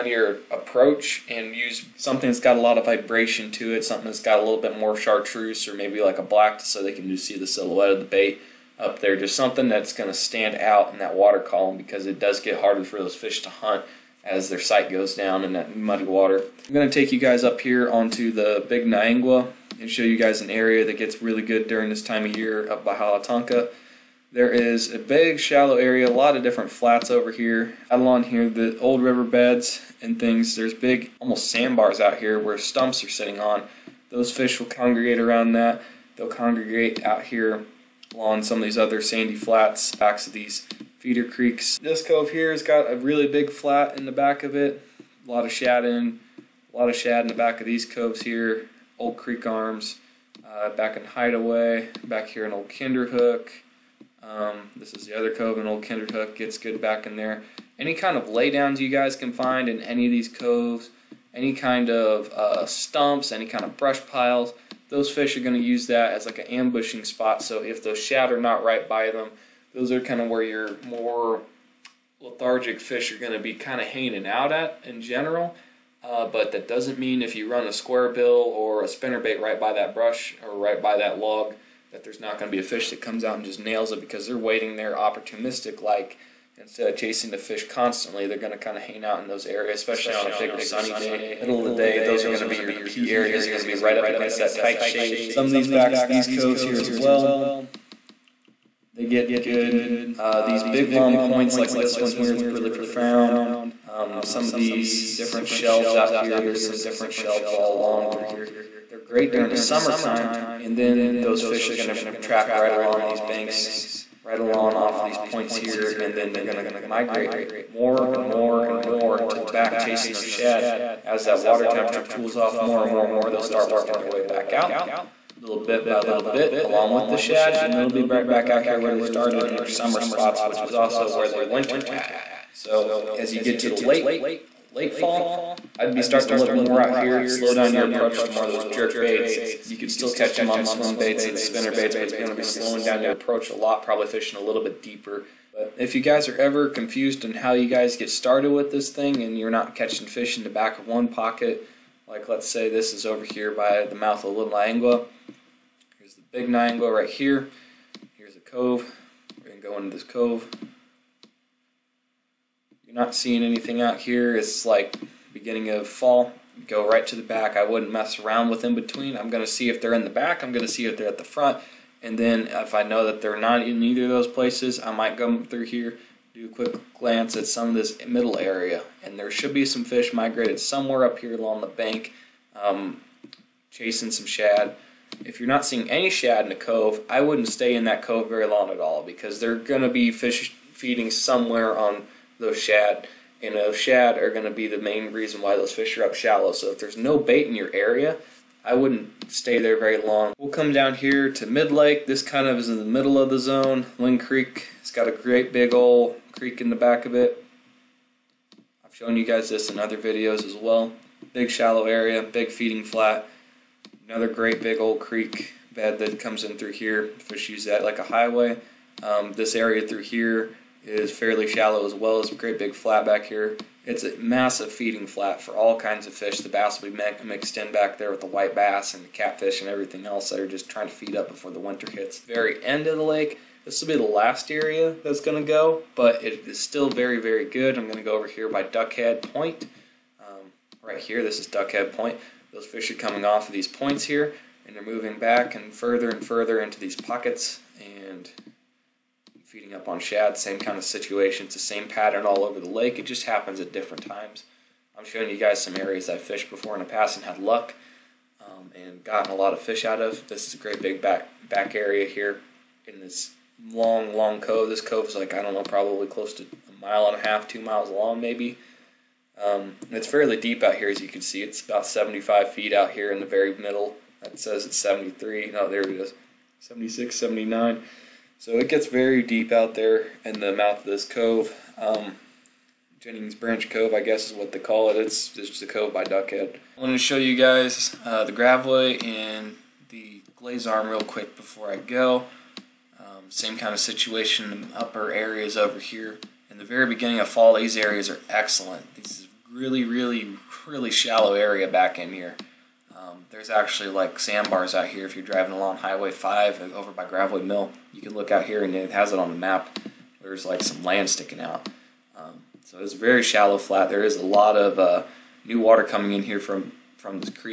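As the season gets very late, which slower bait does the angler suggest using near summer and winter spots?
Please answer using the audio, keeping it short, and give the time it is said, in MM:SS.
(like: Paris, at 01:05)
Jerk baits, at 02:18.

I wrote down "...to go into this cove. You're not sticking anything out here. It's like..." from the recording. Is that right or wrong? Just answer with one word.
wrong.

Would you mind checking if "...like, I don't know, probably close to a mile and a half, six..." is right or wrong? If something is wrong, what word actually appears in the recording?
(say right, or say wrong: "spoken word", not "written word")
wrong: "two", not "six".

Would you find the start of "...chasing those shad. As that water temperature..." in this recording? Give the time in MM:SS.
01:59.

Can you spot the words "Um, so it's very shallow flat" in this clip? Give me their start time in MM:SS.
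05:12.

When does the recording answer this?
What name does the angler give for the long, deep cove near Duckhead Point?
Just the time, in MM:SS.
04:42.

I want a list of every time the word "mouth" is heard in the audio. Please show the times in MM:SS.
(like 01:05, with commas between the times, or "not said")
02:33, 04:40.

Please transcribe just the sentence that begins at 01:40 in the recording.
Uh, these big long points like this one here, it's really profound.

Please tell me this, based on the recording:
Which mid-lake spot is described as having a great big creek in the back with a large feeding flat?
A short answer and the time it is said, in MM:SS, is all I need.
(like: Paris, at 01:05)
Linn Creek, at 03:23.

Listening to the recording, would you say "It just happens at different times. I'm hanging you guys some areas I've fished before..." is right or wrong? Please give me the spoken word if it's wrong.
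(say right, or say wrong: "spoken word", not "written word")
wrong: "showing", not "hanging".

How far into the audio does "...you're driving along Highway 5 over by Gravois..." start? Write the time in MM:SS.
05:05.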